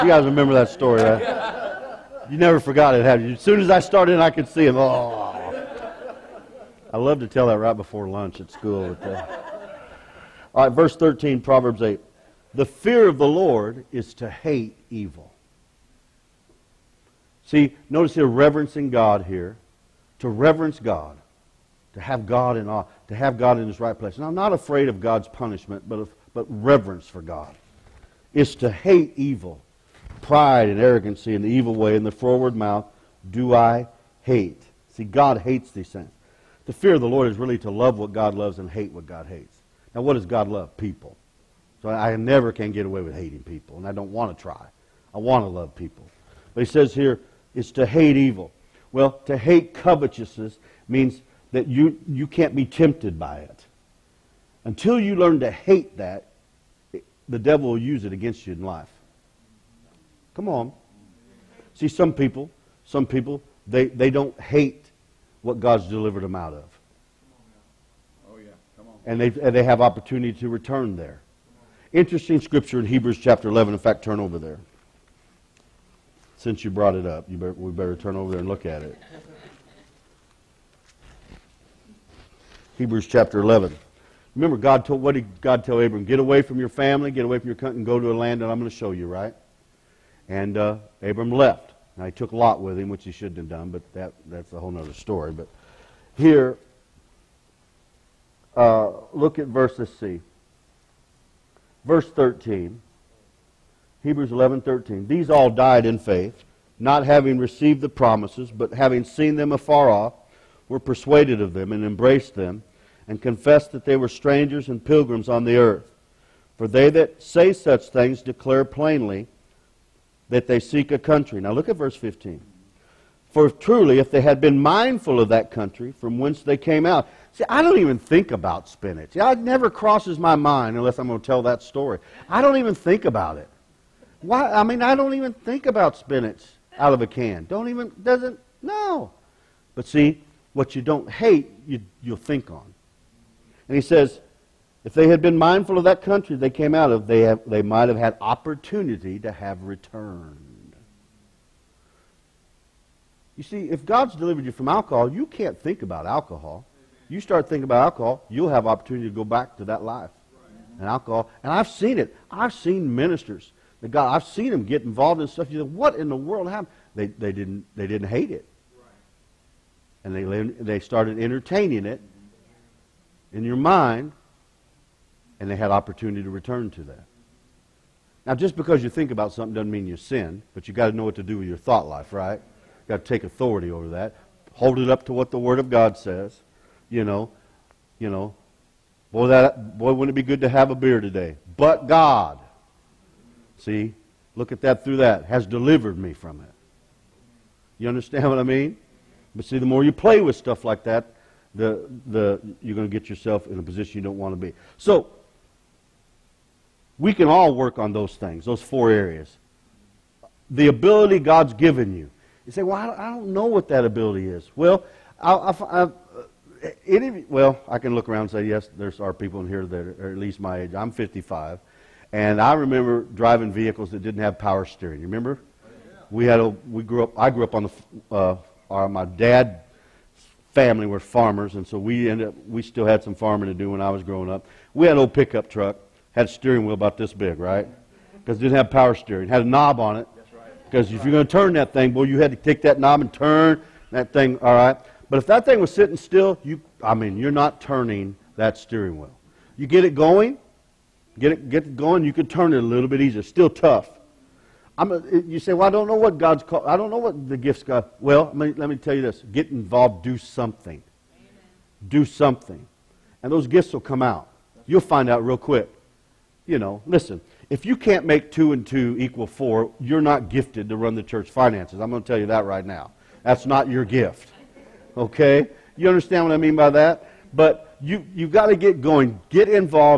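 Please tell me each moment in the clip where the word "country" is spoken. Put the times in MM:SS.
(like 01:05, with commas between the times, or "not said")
01:27, 02:00, 02:05, 02:26.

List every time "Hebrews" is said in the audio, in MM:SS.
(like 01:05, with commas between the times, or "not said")
01:12, 01:22, 01:44.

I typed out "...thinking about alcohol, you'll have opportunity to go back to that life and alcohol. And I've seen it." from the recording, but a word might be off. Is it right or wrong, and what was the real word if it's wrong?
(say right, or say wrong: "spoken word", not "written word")
right.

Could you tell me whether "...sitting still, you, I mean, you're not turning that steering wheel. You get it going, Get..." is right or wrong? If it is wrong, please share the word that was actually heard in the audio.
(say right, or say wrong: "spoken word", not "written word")
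right.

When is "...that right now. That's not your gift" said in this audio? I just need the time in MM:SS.
04:32.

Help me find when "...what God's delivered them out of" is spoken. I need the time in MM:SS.
01:05.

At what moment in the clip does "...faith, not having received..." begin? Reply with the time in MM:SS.
01:45.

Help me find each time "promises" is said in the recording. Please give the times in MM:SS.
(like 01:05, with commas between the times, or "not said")
01:47.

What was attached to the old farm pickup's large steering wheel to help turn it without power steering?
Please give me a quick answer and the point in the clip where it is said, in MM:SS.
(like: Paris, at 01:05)
A knob, at 03:59.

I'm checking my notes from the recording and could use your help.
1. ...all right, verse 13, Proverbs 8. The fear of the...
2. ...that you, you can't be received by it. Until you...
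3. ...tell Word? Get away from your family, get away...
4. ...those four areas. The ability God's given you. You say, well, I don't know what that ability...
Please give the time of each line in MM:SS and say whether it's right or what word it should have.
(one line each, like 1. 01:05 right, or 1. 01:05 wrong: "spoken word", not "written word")
1. 00:10 right
2. 00:51 wrong: "tempted", not "received"
3. 01:25 wrong: "Abram", not "Word"
4. 03:28 right.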